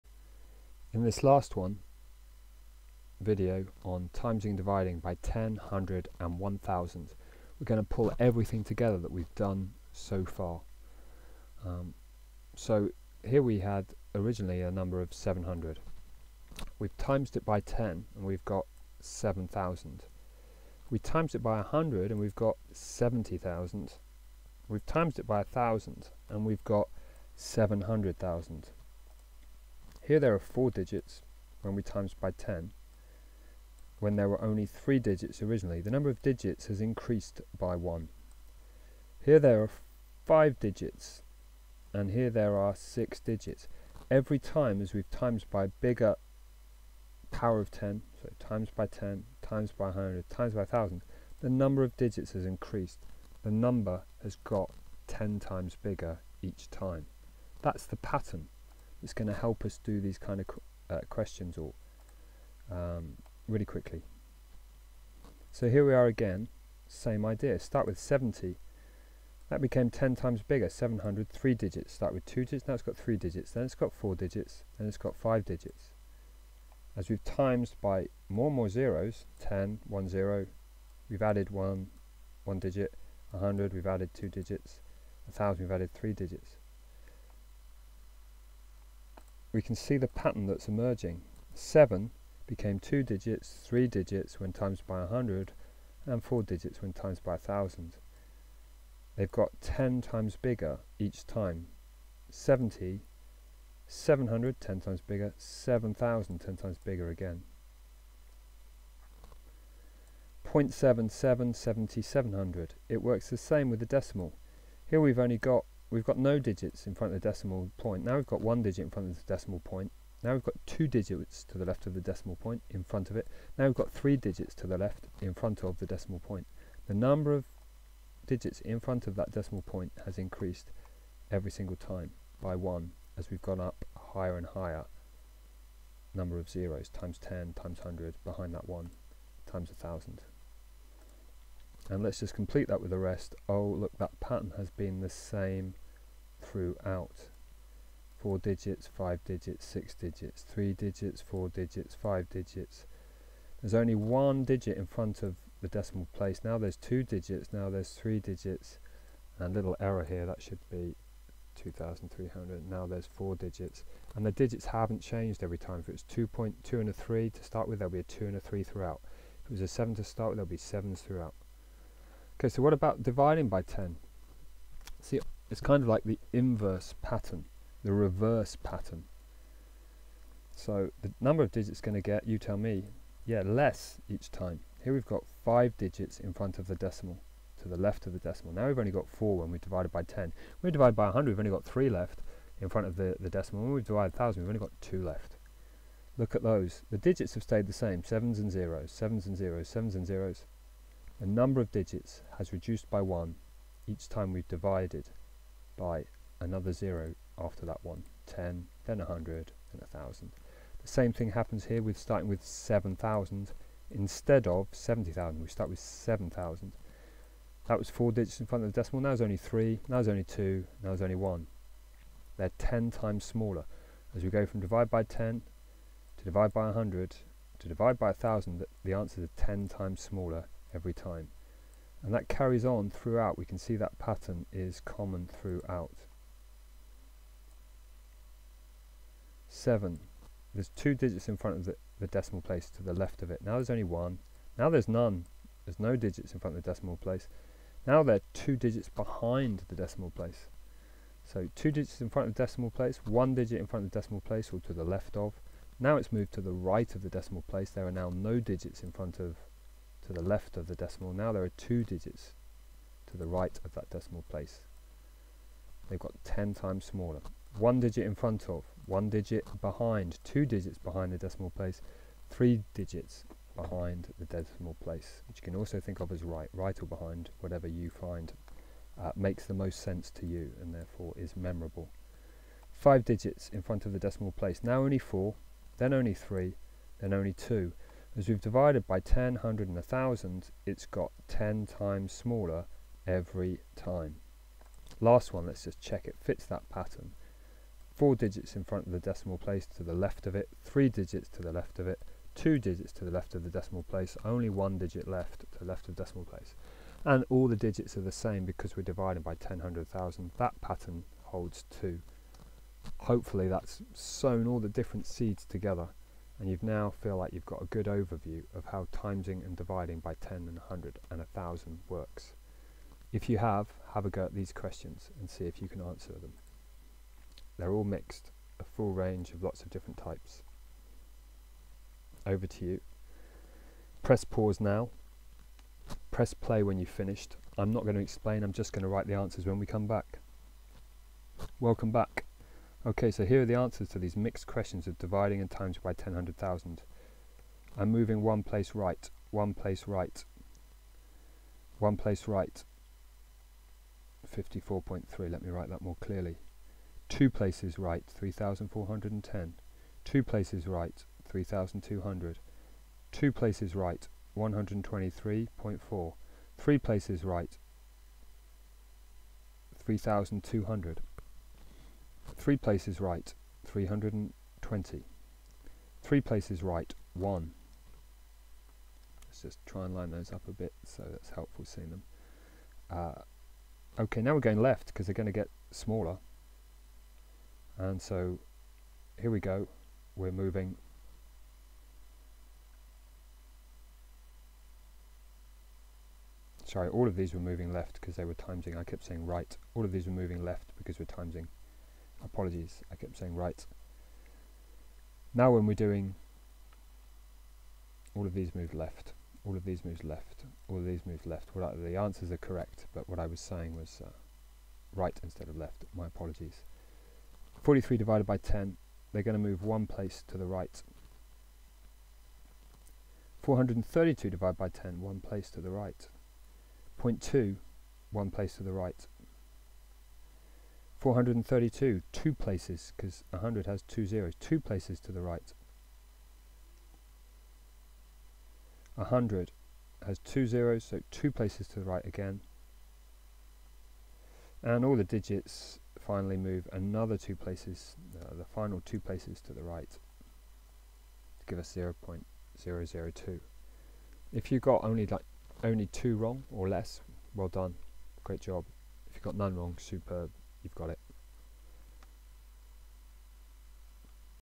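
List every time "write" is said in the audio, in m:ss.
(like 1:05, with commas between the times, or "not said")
5:38, 5:55.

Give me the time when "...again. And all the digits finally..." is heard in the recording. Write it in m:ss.
7:22.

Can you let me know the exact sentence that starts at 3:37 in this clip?
That was four digits in front of the decimal.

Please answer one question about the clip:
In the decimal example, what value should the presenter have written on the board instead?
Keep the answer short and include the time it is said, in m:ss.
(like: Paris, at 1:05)
2300, at 2:41.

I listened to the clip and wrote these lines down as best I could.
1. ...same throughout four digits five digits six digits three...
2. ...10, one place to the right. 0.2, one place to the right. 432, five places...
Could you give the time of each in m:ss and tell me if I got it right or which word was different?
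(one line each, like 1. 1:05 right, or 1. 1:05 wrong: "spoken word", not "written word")
1. 2:25 right
2. 7:04 wrong: "two", not "five".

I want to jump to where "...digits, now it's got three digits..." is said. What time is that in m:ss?
1:12.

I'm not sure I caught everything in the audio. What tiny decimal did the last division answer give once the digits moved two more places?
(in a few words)
0.002.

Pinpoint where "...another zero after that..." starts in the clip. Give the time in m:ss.
3:26.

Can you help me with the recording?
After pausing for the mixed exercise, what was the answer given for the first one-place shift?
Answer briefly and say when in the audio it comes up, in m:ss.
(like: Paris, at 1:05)
54.3, at 5:54.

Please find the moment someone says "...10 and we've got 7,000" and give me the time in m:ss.
0:17.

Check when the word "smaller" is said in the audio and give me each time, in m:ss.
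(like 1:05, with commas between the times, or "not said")
3:43, 3:50, 4:26, 4:52, 6:25.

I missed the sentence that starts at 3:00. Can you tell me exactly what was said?
So the number of digits going to get, you tell me, yeah, less each time.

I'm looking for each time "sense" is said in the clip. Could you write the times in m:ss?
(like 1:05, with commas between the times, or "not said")
4:39.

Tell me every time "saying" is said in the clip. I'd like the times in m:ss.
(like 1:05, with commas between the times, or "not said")
6:39, 6:43, 6:53.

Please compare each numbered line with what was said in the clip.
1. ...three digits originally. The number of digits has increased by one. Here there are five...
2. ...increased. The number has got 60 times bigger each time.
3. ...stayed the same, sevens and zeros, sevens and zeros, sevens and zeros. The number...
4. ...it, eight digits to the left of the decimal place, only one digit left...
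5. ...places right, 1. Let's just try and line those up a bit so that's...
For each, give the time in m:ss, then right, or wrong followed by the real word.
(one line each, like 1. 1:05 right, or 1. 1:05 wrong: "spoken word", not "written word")
1. 0:34 right
2. 0:52 wrong: "10", not "60"
3. 3:17 right
4. 5:01 wrong: "two", not "eight"
5. 6:16 right.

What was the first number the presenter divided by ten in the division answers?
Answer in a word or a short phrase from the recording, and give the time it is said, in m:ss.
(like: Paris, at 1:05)
43, at 6:57.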